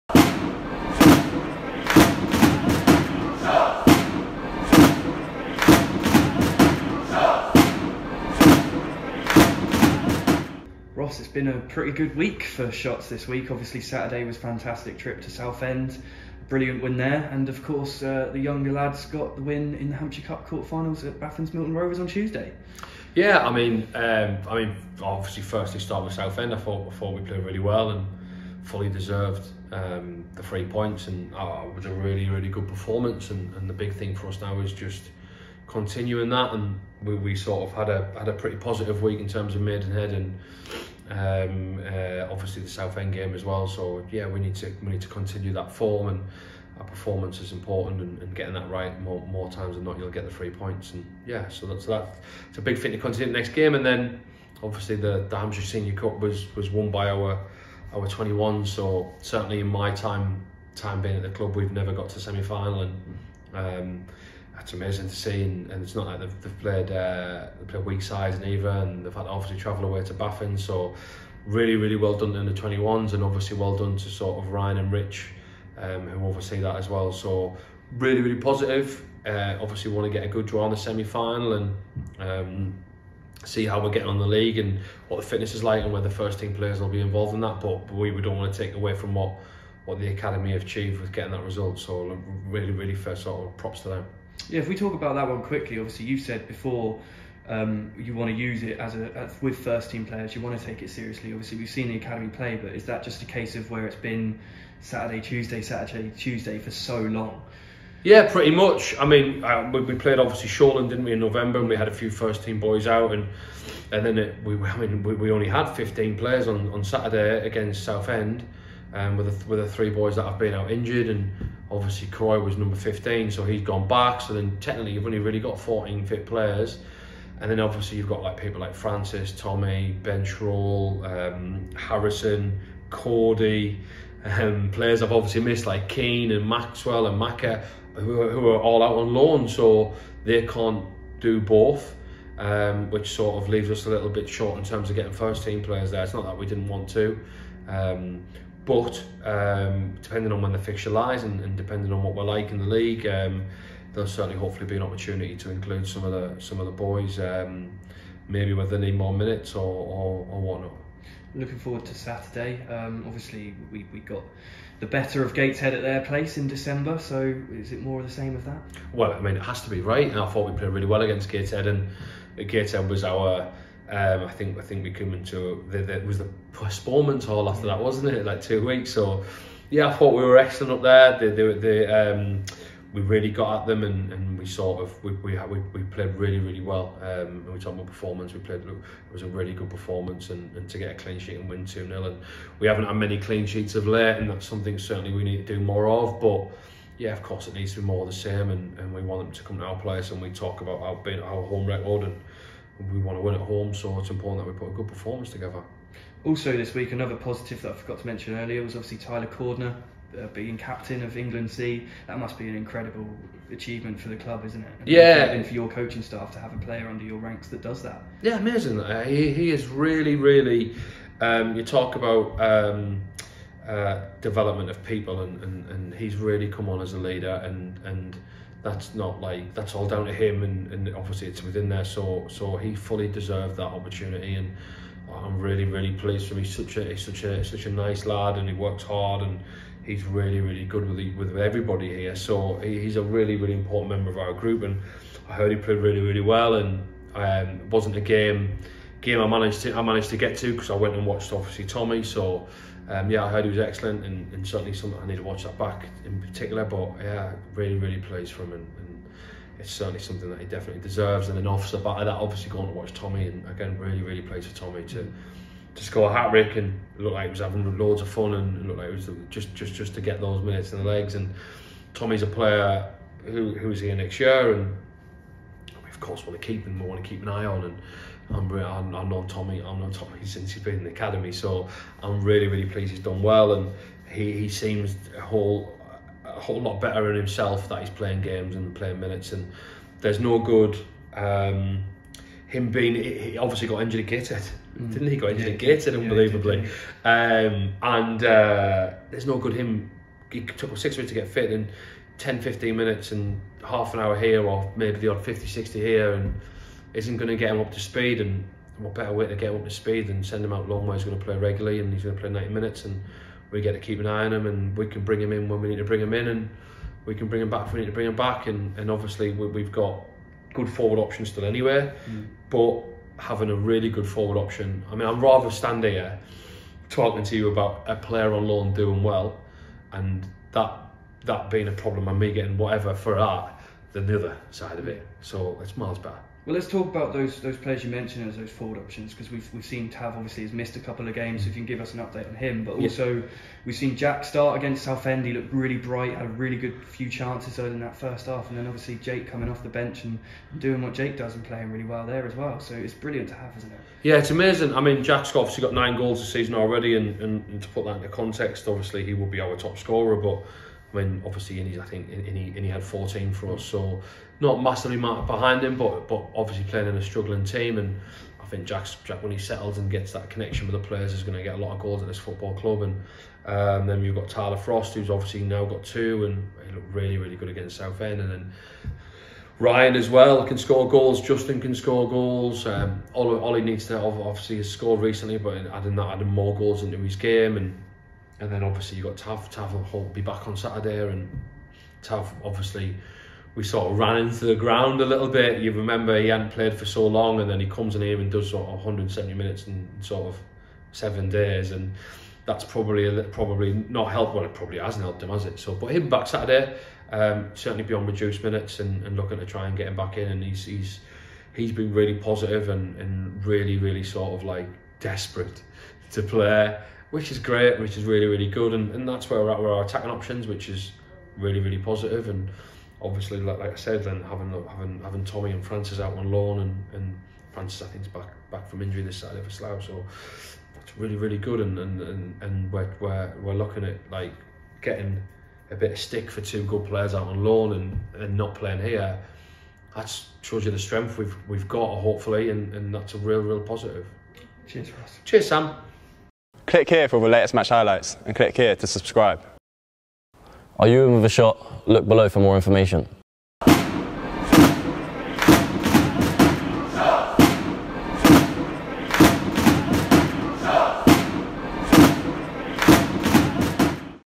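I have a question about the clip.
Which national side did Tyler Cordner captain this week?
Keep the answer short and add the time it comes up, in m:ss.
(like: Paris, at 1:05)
England C, at 3:31.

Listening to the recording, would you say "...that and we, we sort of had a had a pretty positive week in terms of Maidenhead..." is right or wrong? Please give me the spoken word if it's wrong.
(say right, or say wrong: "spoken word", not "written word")
right.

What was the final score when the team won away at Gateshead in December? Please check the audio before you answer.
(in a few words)
2-0.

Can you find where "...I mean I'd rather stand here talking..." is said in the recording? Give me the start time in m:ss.
5:24.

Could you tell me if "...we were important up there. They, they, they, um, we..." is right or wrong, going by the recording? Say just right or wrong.
wrong.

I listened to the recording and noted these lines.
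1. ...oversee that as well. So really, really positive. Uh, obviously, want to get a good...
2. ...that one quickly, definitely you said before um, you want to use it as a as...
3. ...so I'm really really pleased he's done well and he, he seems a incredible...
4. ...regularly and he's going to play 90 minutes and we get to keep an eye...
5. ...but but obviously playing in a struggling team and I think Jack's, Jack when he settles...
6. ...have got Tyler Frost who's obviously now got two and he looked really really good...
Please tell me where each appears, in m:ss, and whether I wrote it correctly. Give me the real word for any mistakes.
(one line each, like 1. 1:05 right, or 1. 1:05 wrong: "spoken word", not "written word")
1. 1:16 right
2. 1:35 wrong: "obviously", not "definitely"
3. 4:41 wrong: "whole", not "incredible"
4. 5:11 right
5. 6:05 right
6. 6:14 right.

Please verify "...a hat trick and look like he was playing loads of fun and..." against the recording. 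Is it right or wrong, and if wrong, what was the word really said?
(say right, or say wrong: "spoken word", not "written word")
wrong: "having", not "playing".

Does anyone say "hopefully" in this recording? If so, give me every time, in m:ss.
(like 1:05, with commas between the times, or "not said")
2:34, 7:21.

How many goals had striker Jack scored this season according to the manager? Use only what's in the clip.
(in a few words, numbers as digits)
9.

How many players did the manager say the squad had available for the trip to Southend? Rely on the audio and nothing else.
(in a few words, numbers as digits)
15.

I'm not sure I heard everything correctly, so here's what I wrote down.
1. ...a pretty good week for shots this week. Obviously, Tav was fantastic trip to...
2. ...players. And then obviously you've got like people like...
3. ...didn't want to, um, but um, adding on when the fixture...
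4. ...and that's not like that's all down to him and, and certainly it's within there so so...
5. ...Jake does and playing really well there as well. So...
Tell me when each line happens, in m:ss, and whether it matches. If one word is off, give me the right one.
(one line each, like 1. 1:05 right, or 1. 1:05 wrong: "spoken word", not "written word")
1. 0:11 wrong: "Saturday", not "Tav"
2. 2:06 right
3. 2:26 wrong: "depending", not "adding"
4. 3:47 wrong: "obviously", not "certainly"
5. 5:50 right.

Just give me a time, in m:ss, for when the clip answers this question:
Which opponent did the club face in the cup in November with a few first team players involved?
1:50.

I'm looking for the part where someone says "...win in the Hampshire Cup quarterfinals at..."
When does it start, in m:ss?
0:19.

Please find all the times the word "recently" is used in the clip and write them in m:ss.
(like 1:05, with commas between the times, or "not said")
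6:25.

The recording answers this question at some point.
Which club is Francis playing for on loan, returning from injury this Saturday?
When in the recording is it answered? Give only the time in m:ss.
7:09.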